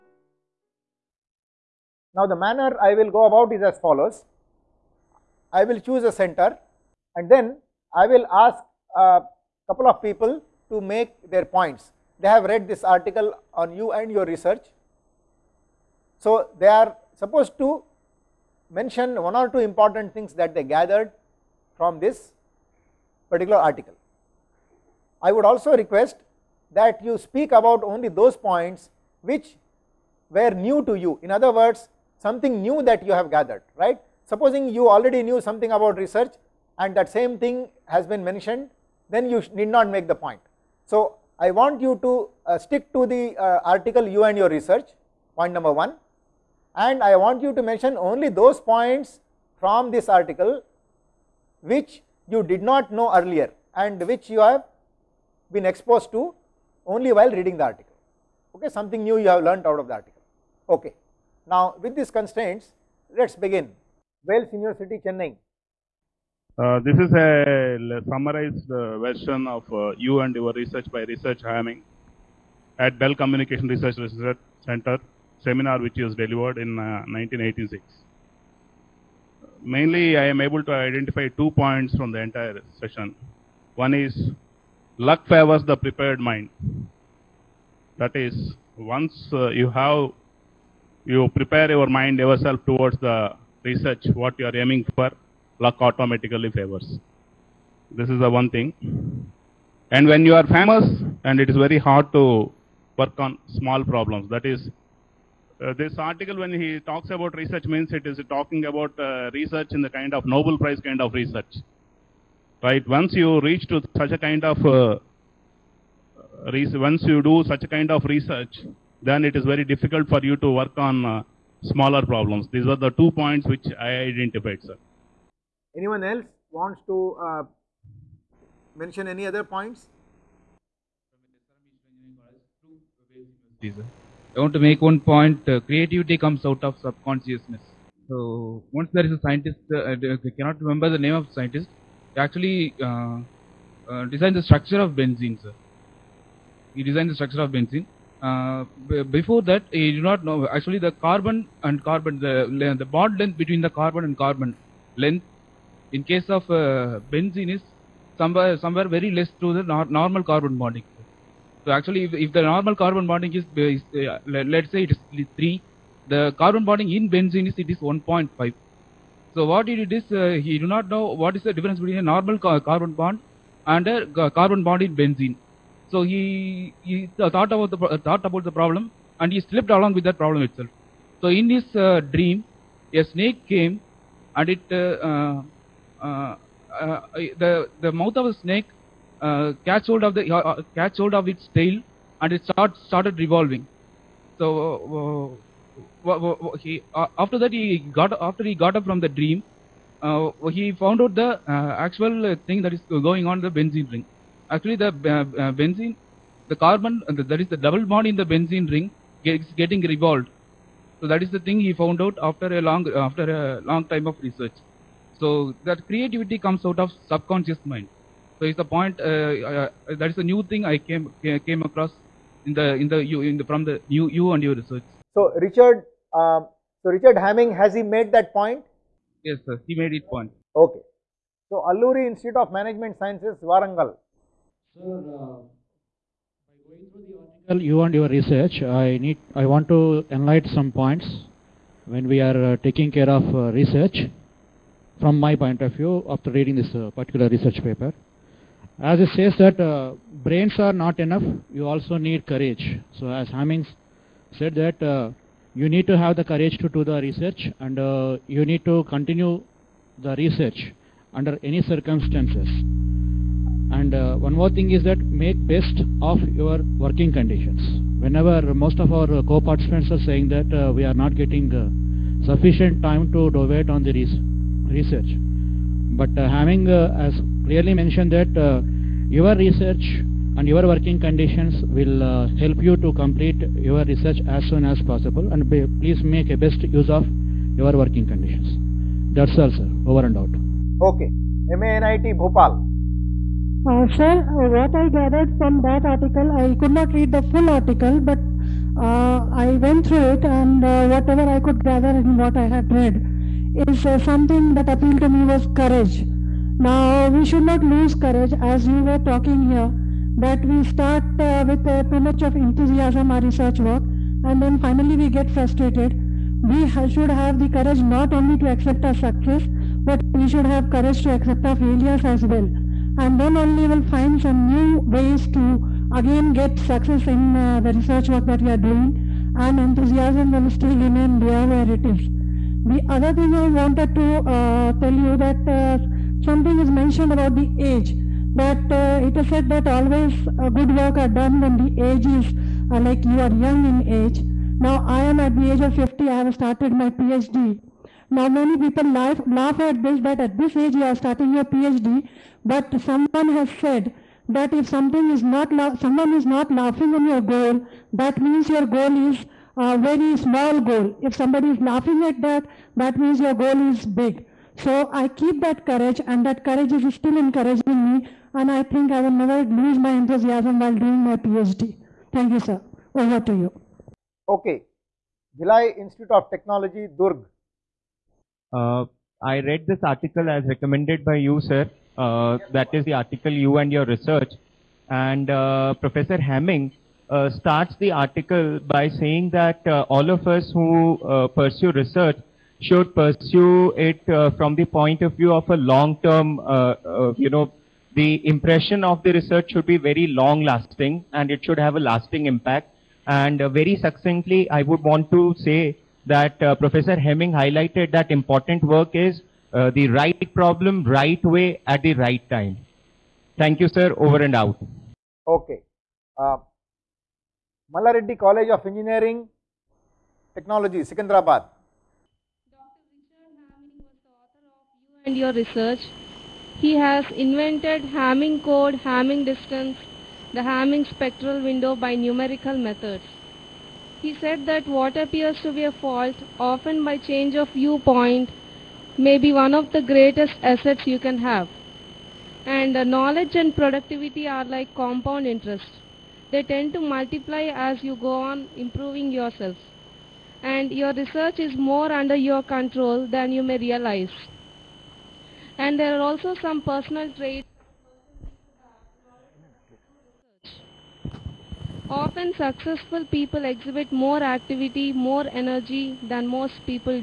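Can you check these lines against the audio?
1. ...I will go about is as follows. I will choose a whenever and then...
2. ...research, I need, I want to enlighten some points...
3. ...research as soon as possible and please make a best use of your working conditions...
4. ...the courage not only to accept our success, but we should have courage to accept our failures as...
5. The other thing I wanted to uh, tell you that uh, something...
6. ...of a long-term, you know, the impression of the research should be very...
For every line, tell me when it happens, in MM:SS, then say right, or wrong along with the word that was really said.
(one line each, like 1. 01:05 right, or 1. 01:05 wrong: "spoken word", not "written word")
1. 00:02 wrong: "center", not "whenever"
2. 03:58 right
3. 04:43 right
4. 05:17 right
5. 05:32 right
6. 06:35 right.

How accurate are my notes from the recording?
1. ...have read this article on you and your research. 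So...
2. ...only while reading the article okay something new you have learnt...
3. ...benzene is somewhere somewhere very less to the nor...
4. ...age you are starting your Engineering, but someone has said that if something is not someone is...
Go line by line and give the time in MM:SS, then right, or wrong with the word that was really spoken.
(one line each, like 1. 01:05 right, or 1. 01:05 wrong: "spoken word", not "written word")
1. 00:12 right
2. 00:56 right
3. 02:37 right
4. 05:50 wrong: "PhD", not "Engineering".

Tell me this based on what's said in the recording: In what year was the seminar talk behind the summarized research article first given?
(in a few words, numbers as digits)
1986.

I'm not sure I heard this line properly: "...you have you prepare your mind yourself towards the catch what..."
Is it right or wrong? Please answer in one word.
wrong.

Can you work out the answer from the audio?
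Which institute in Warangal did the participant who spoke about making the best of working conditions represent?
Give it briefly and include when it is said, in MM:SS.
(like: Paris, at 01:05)
Alluri Institute of Management Sciences, at 03:51.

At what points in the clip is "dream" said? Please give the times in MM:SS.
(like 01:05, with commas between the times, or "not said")
03:02, 03:19.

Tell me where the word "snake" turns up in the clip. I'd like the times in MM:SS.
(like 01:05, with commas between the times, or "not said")
03:03, 03:08.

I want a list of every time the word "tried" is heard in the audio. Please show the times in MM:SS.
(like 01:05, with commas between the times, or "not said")
not said.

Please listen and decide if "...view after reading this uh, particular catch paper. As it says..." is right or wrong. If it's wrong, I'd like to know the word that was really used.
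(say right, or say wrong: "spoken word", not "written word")
wrong: "research", not "catch".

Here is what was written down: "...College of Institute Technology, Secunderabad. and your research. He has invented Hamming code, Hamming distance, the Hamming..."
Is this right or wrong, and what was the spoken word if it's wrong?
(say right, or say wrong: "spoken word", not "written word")
wrong: "Engineering", not "Institute".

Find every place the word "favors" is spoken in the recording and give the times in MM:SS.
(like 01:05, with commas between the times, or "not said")
01:25, 01:36.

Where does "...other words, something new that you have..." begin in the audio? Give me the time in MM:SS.
00:31.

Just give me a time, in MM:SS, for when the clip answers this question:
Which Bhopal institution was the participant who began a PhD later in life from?
04:51.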